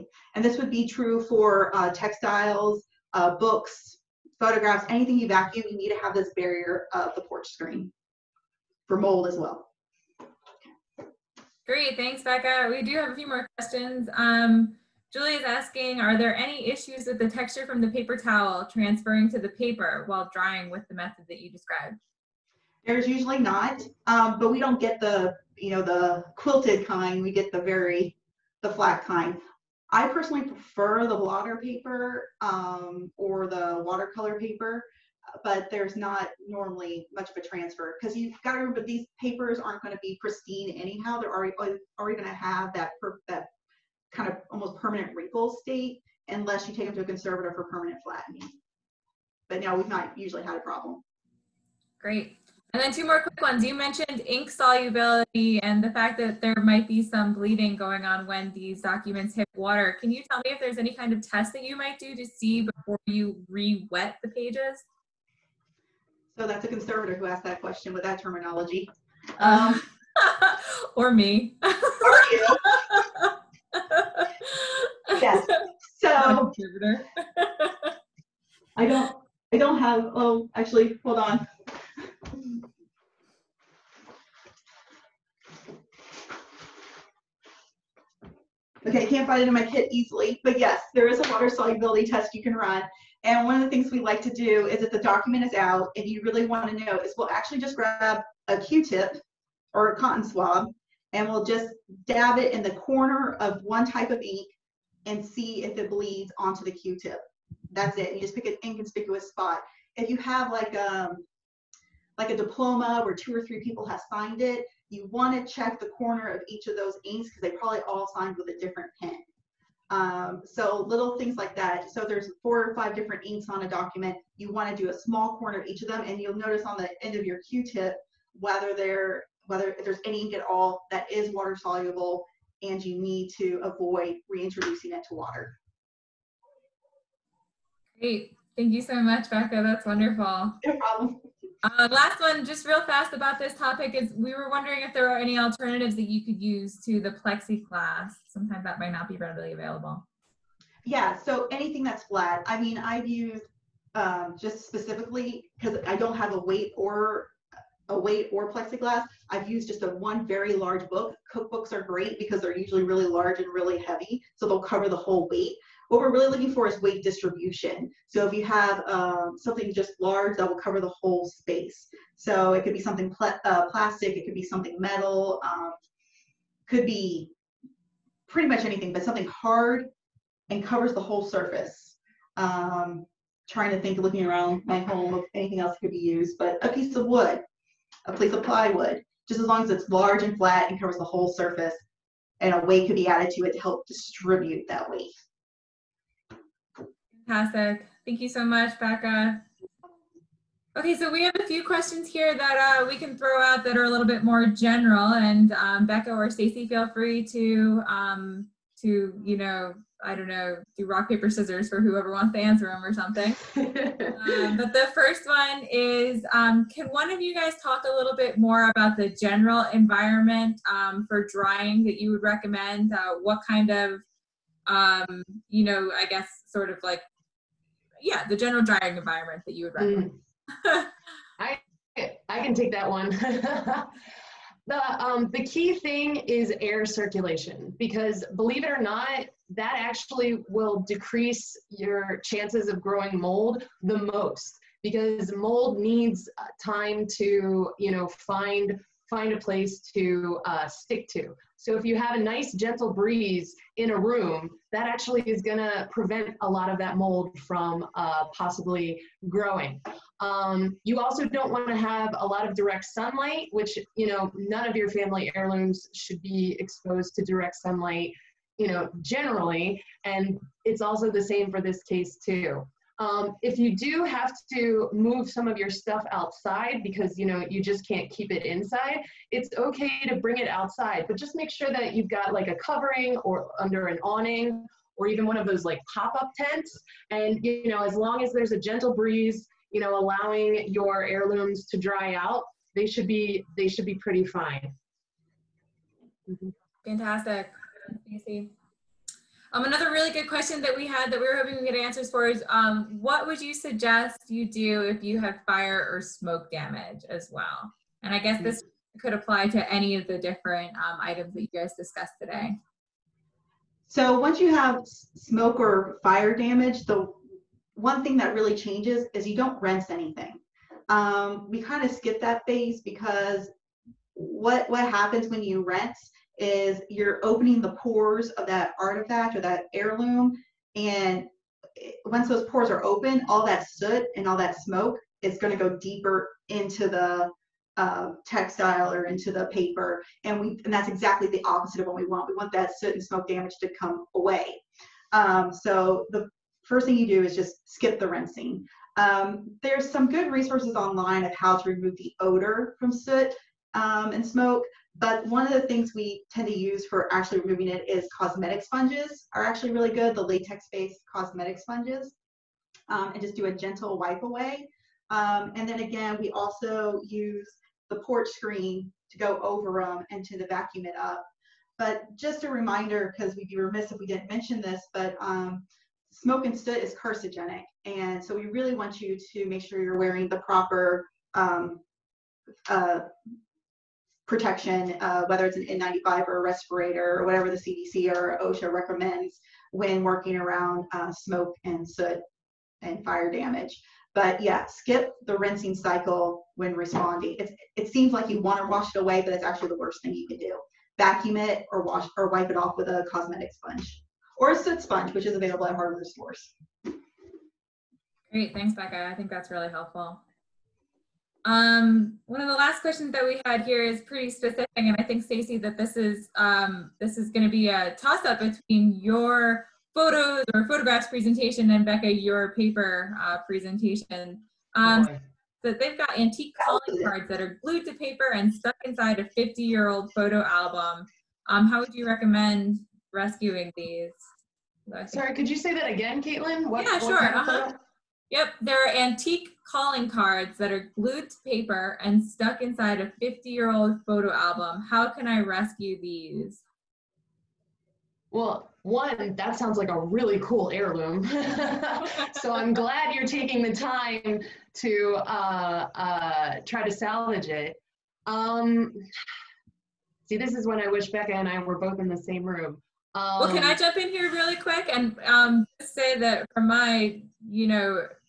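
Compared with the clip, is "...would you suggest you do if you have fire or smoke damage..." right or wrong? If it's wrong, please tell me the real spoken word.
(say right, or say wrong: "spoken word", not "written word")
right.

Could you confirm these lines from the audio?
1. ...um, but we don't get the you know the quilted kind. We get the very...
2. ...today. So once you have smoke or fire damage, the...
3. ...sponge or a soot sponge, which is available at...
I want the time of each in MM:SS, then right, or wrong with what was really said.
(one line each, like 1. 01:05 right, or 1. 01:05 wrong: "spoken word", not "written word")
1. 00:24 right
2. 05:12 right
3. 06:43 right.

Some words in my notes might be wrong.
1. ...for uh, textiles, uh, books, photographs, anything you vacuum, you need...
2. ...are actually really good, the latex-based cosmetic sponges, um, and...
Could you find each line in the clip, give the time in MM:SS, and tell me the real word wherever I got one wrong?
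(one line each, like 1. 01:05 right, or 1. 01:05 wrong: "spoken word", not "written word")
1. 00:01 right
2. 05:59 right.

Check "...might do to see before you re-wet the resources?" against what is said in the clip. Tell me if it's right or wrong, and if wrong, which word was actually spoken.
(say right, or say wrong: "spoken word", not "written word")
wrong: "pages", not "resources".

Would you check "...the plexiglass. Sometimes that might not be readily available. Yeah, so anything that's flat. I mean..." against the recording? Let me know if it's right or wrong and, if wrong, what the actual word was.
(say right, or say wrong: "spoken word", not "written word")
right.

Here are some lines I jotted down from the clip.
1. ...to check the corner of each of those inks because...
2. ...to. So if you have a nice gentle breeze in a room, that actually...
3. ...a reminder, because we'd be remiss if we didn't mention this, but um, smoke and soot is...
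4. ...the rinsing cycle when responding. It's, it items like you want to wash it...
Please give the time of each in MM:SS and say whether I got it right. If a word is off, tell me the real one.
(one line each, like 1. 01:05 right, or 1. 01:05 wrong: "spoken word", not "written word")
1. 01:55 right
2. 04:11 right
3. 06:12 right
4. 06:35 wrong: "seems", not "items".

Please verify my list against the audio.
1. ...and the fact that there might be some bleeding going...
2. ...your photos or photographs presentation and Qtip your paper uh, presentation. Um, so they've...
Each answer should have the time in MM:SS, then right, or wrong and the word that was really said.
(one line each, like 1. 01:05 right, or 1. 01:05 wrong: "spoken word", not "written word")
1. 00:55 right
2. 06:59 wrong: "Becca", not "Qtip".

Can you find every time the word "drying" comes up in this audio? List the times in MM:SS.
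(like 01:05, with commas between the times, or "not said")
00:20, 03:41, 03:48.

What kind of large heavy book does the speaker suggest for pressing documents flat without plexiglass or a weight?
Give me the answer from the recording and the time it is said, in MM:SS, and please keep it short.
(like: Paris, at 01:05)
Cookbooks, at 02:41.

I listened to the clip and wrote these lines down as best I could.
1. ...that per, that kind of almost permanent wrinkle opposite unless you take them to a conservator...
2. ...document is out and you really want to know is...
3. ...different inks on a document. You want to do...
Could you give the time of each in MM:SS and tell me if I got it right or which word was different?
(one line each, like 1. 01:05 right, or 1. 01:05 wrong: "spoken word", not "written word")
1. 00:42 wrong: "state", not "opposite"
2. 01:34 right
3. 02:02 right.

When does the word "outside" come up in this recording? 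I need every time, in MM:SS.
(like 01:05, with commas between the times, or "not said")
04:36, 04:40.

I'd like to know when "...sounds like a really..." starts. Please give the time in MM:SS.
07:29.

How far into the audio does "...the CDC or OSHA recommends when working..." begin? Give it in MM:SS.
06:27.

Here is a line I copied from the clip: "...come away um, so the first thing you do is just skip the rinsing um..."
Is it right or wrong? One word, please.
right.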